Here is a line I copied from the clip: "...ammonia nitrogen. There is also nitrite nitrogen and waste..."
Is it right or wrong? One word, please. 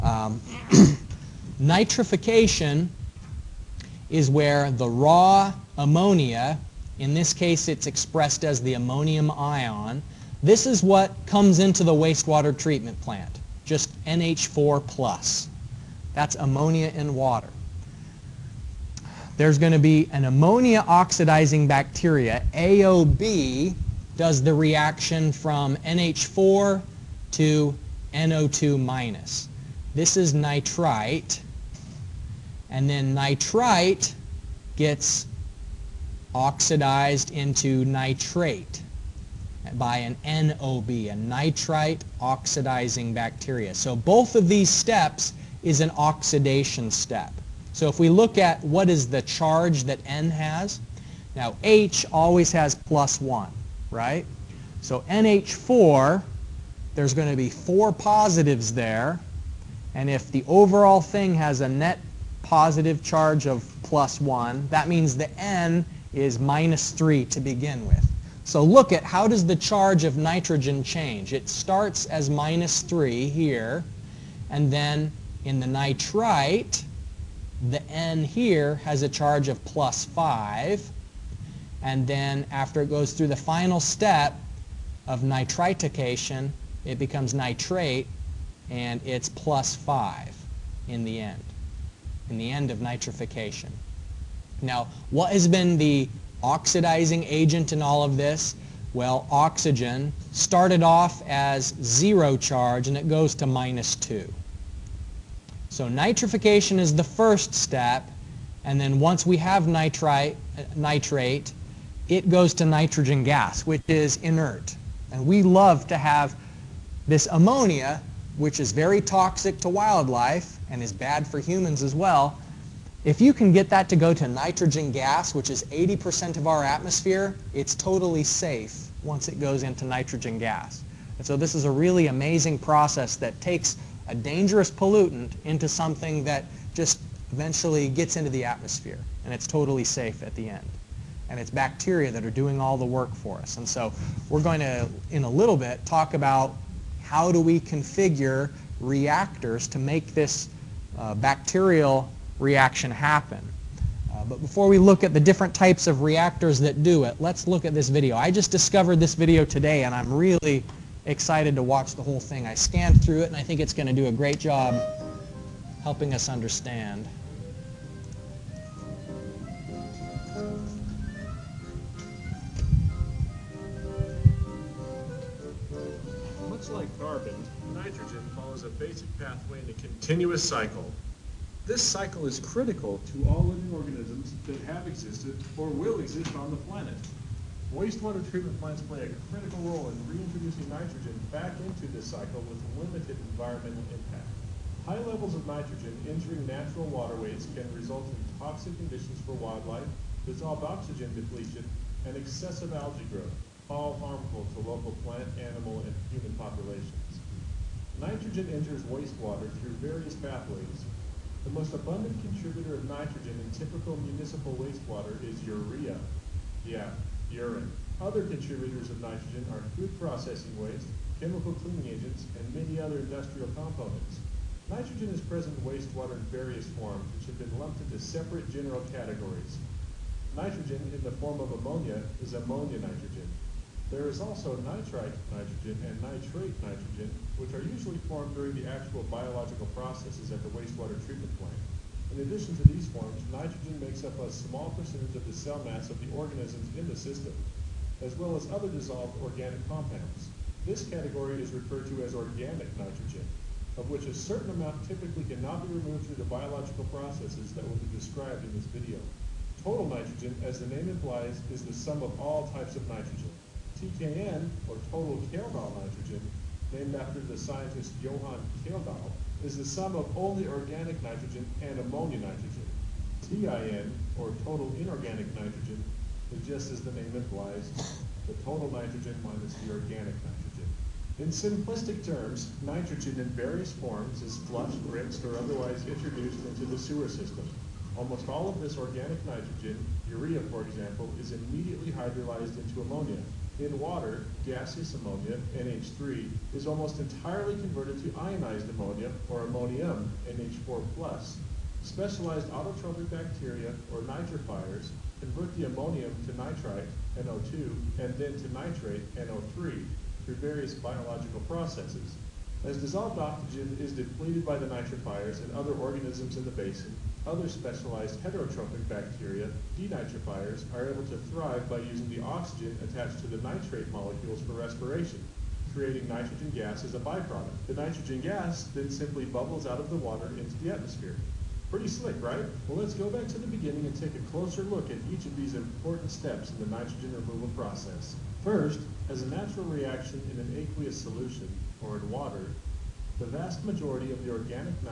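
wrong.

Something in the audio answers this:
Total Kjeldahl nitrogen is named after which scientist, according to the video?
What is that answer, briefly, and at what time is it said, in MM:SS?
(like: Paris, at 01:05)
Johann Kjeldahl, at 04:28.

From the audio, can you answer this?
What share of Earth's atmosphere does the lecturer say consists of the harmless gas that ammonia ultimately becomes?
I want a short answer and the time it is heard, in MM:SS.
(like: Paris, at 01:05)
80%, at 02:05.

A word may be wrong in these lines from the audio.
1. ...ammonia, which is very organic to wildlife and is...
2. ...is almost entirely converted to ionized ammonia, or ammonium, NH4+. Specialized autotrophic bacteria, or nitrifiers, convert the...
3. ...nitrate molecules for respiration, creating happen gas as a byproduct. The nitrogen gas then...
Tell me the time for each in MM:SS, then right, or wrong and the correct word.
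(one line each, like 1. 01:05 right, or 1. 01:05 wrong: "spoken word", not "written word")
1. 01:57 wrong: "toxic", not "organic"
2. 04:56 right
3. 05:23 wrong: "nitrogen", not "happen".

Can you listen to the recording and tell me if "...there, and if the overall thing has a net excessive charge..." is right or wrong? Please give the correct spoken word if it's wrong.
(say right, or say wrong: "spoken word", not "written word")
wrong: "positive", not "excessive".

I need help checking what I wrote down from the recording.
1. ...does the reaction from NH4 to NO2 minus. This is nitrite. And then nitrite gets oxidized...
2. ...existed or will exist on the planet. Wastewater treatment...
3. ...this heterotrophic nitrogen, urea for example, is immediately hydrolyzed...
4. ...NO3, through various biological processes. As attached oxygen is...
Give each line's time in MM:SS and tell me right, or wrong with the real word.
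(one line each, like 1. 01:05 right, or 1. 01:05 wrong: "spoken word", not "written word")
1. 00:24 right
2. 03:04 right
3. 04:48 wrong: "organic", not "heterotrophic"
4. 05:09 wrong: "dissolved", not "attached".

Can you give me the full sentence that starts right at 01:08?
So look at how does the charge of nitrogen change.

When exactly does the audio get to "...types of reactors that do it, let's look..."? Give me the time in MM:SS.
02:35.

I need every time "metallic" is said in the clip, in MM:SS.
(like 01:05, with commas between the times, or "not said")
not said.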